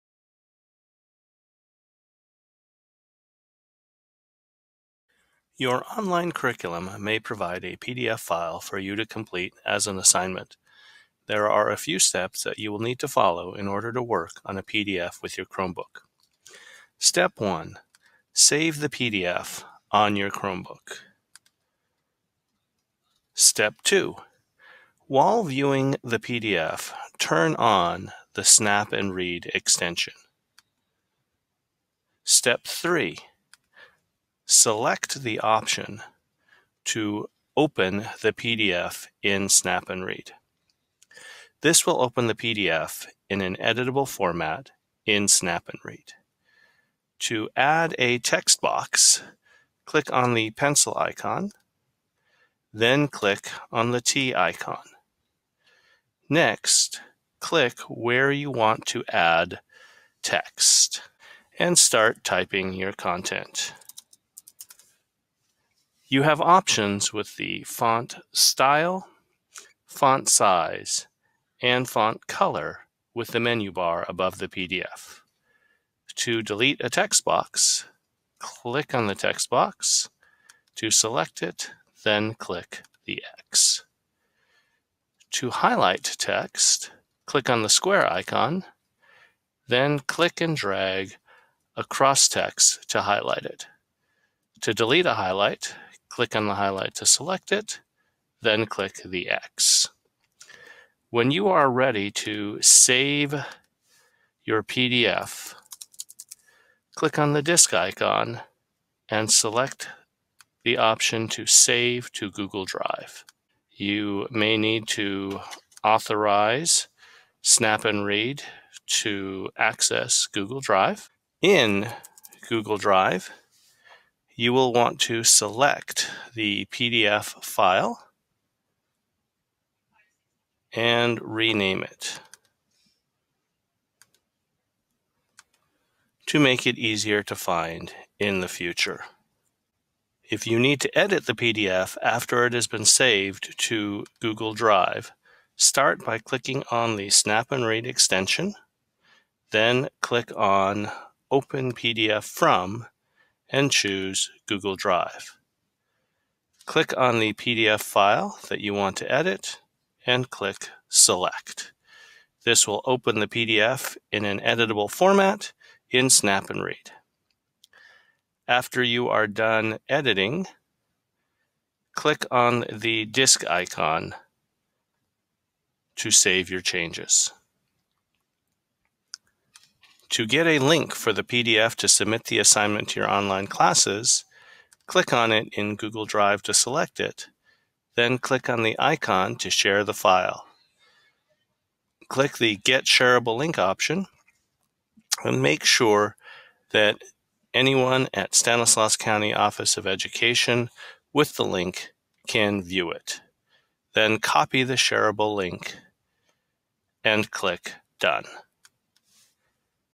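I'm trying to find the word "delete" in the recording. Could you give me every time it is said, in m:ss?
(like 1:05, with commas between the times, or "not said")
1:16, 1:34.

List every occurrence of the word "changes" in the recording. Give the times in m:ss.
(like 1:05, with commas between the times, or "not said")
2:56.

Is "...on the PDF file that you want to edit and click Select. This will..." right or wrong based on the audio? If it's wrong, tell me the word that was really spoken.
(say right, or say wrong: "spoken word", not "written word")
right.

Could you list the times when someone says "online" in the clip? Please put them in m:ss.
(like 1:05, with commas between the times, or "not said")
0:05, 3:03.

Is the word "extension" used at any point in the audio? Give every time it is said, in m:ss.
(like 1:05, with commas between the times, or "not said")
0:29, 2:27.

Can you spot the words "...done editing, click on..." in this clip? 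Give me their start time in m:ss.
2:49.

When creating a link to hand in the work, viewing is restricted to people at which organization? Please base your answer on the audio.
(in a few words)
Stanislaus County Office of Education.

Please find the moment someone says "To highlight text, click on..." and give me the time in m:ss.
1:25.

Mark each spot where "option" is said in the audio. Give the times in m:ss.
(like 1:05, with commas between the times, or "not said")
0:35, 1:06, 1:50, 3:13.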